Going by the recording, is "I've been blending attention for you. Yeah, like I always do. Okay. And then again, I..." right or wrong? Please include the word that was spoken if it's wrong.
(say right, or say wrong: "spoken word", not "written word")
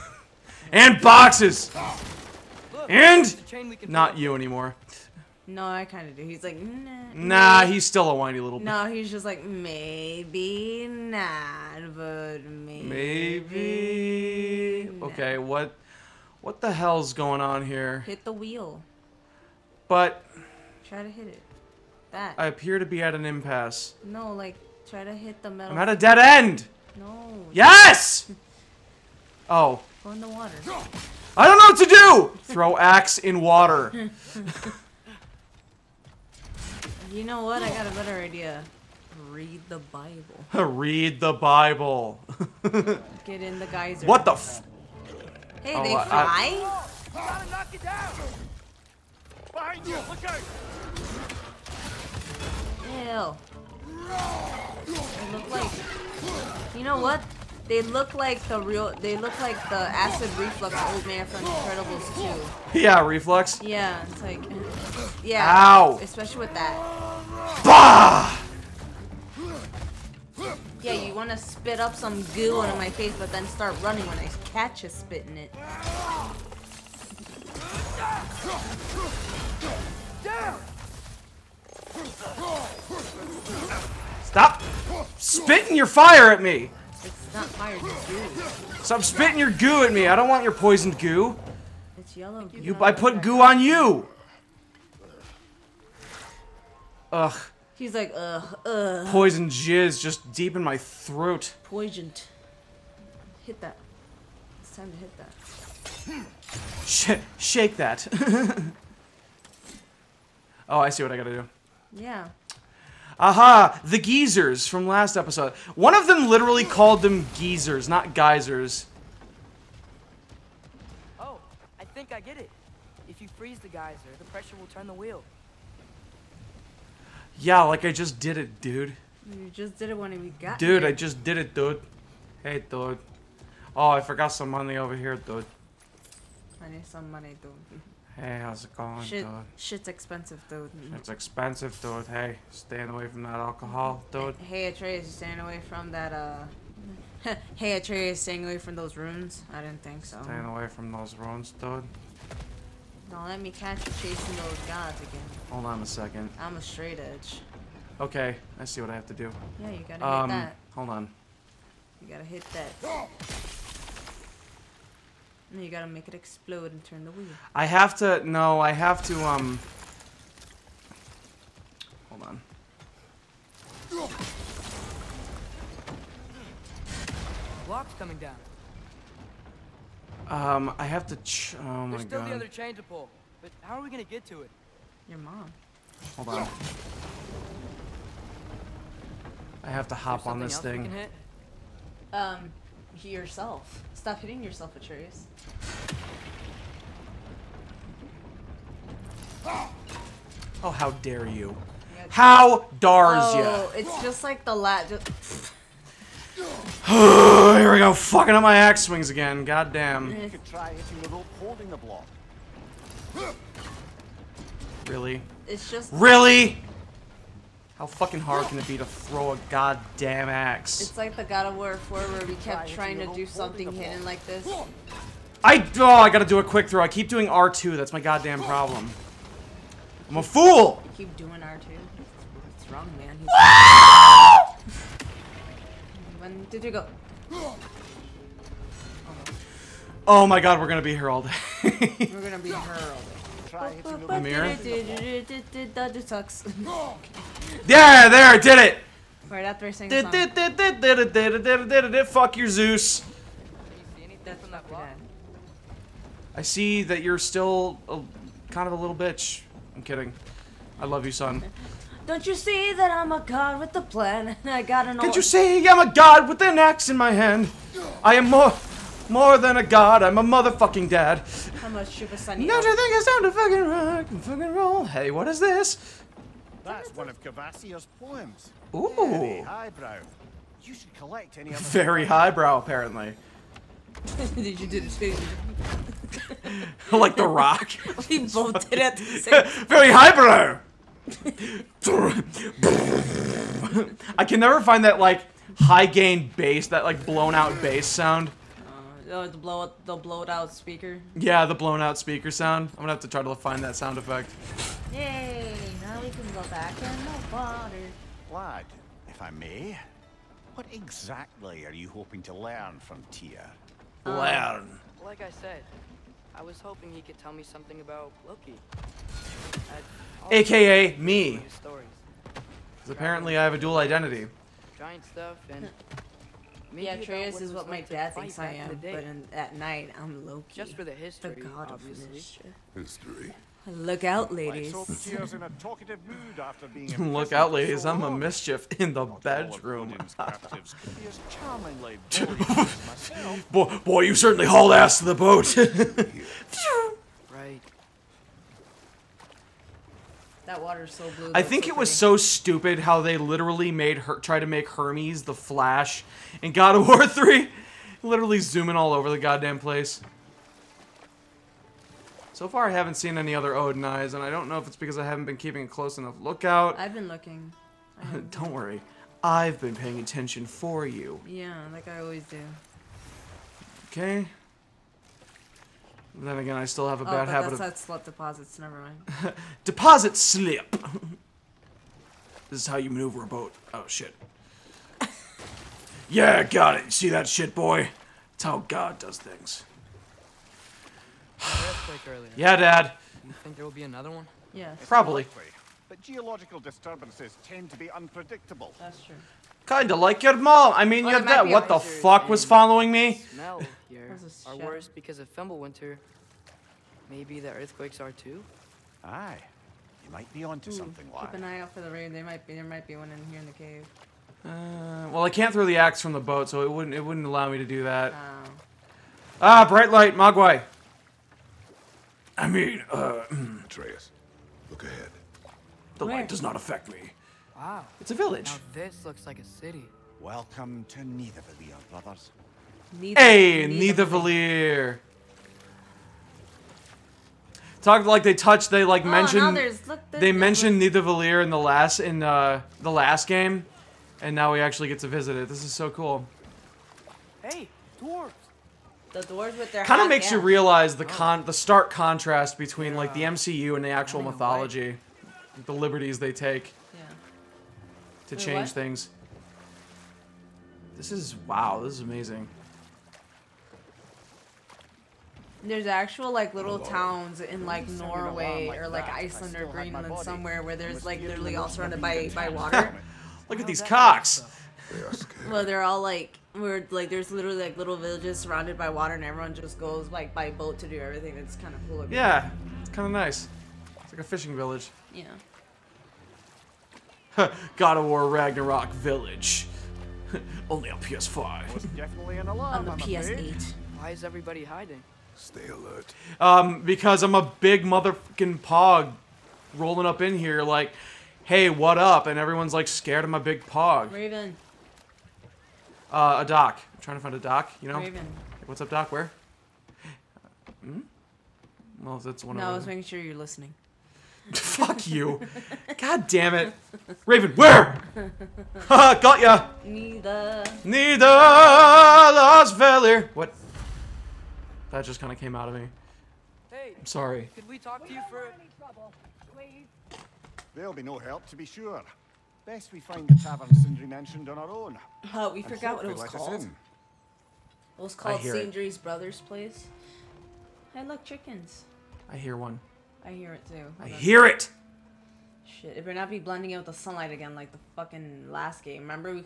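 wrong: "paying", not "blending".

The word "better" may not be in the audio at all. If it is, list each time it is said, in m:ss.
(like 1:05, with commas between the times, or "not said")
0:37, 9:06.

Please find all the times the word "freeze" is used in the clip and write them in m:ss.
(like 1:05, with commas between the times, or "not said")
2:03.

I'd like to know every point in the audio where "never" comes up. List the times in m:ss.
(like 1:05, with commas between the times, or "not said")
4:54, 6:18.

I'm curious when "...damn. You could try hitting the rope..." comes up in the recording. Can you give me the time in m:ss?
3:29.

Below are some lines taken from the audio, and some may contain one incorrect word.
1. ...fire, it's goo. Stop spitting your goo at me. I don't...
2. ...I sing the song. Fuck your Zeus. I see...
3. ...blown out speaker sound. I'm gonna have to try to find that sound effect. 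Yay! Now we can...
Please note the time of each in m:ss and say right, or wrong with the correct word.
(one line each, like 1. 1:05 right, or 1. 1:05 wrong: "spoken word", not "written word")
1. 1:27 right
2. 4:09 right
3. 5:01 right.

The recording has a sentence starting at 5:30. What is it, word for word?
Just for the history, the god of mischief.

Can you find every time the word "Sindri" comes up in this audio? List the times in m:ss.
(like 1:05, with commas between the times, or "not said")
8:53, 8:58.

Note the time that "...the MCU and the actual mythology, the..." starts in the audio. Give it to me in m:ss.
7:33.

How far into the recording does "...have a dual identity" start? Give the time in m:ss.
5:23.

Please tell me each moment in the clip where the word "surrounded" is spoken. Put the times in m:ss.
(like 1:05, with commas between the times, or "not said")
7:51, 7:58.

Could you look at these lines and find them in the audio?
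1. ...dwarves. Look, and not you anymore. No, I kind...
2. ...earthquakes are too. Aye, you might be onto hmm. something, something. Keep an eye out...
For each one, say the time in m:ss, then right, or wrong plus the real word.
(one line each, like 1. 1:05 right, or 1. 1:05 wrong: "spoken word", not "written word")
1. 0:01 wrong: "boxes", not "dwarves"
2. 6:47 right.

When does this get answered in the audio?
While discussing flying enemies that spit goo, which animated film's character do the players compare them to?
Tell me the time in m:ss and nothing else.
1:01.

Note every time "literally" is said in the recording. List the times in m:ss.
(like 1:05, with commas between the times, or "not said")
1:56, 5:53, 5:58, 7:51, 7:57.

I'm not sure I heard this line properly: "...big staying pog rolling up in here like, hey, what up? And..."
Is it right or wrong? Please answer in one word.
wrong.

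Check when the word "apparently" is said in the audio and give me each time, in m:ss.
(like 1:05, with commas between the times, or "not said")
4:42, 5:22.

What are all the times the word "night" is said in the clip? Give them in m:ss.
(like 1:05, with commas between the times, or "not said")
5:29.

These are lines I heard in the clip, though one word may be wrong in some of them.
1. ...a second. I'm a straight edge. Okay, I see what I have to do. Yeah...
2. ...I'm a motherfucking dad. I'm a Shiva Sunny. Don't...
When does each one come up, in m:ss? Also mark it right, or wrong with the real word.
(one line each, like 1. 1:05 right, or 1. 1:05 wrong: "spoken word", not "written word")
1. 2:35 right
2. 4:30 right.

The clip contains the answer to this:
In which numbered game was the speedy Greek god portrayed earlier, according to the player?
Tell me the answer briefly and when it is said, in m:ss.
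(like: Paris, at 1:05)
God of War 3, at 5:56.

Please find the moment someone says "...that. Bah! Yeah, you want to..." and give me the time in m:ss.
1:06.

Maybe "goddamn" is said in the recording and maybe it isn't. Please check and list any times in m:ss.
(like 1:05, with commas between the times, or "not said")
3:39, 3:47, 5:59.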